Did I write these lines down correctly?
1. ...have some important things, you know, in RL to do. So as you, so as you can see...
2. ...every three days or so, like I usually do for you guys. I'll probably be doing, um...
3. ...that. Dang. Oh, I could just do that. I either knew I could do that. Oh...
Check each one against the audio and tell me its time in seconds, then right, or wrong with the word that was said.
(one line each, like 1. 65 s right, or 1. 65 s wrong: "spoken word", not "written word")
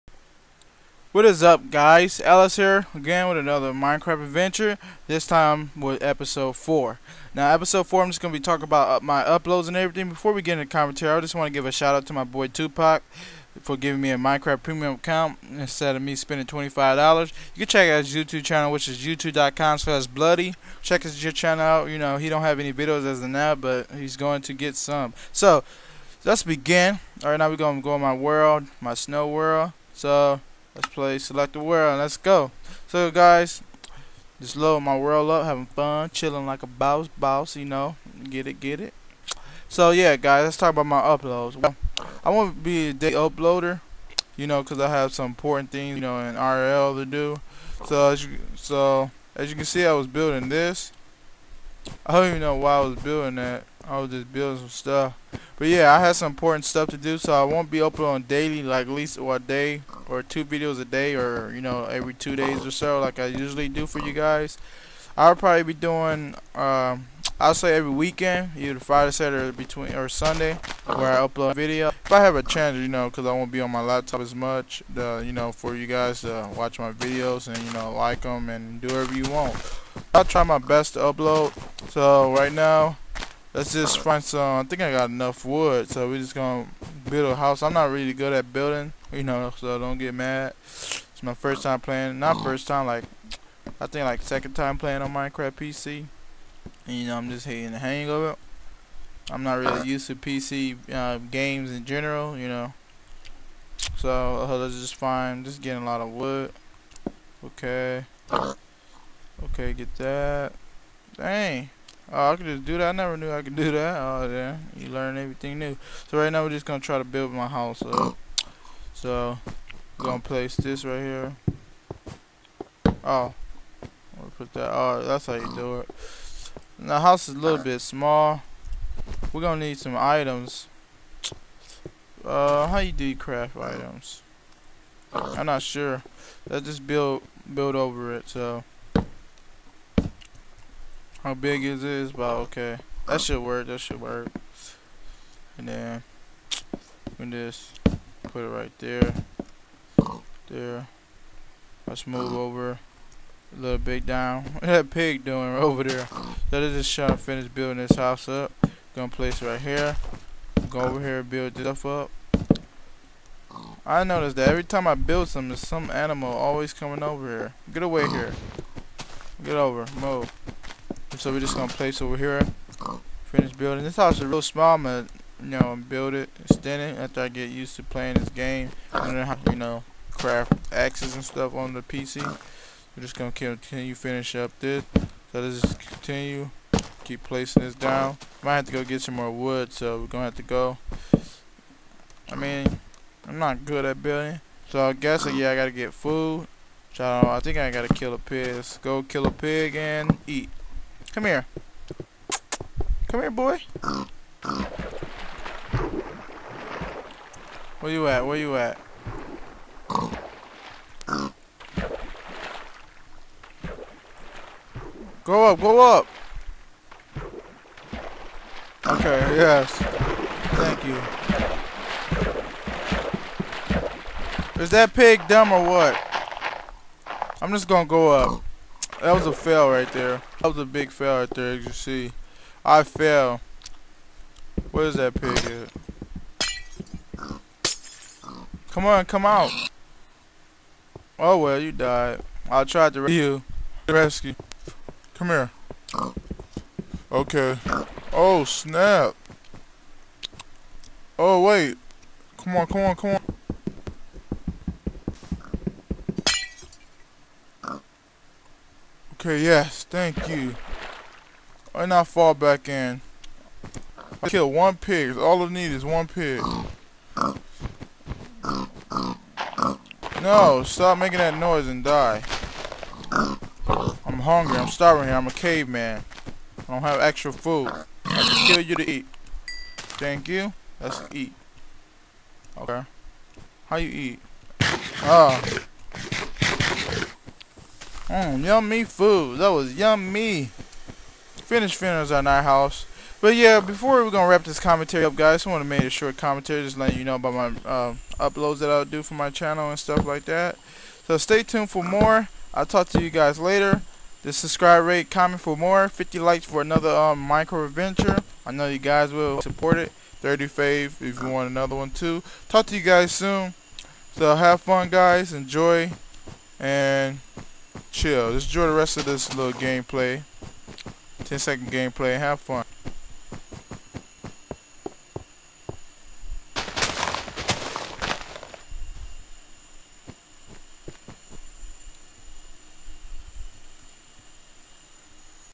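1. 44 s right
2. 61 s wrong: "two", not "three"
3. 109 s wrong: "never", not "either".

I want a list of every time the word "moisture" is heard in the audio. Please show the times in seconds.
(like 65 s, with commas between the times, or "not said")
not said.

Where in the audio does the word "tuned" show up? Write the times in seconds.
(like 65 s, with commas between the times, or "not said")
301 s.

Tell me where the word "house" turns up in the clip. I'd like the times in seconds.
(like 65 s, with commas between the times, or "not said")
87 s, 117 s, 126 s, 157 s, 173 s, 292 s.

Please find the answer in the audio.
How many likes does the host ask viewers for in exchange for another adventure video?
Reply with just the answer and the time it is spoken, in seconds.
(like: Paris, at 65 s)
50, at 305 s.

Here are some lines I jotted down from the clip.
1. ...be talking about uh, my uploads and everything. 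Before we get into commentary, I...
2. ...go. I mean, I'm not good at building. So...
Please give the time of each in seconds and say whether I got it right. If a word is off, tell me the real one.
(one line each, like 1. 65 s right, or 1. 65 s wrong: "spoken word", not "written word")
1. 8 s right
2. 190 s right.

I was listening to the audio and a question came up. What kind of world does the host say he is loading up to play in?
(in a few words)
snow world.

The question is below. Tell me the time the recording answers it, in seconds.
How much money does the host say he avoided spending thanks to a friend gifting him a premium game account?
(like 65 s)
16 s.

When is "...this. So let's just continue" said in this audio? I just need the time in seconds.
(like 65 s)
184 s.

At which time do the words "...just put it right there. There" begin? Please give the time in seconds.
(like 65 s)
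147 s.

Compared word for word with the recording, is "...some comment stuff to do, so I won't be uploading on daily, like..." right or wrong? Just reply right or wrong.
wrong.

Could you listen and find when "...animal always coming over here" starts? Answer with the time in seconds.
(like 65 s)
165 s.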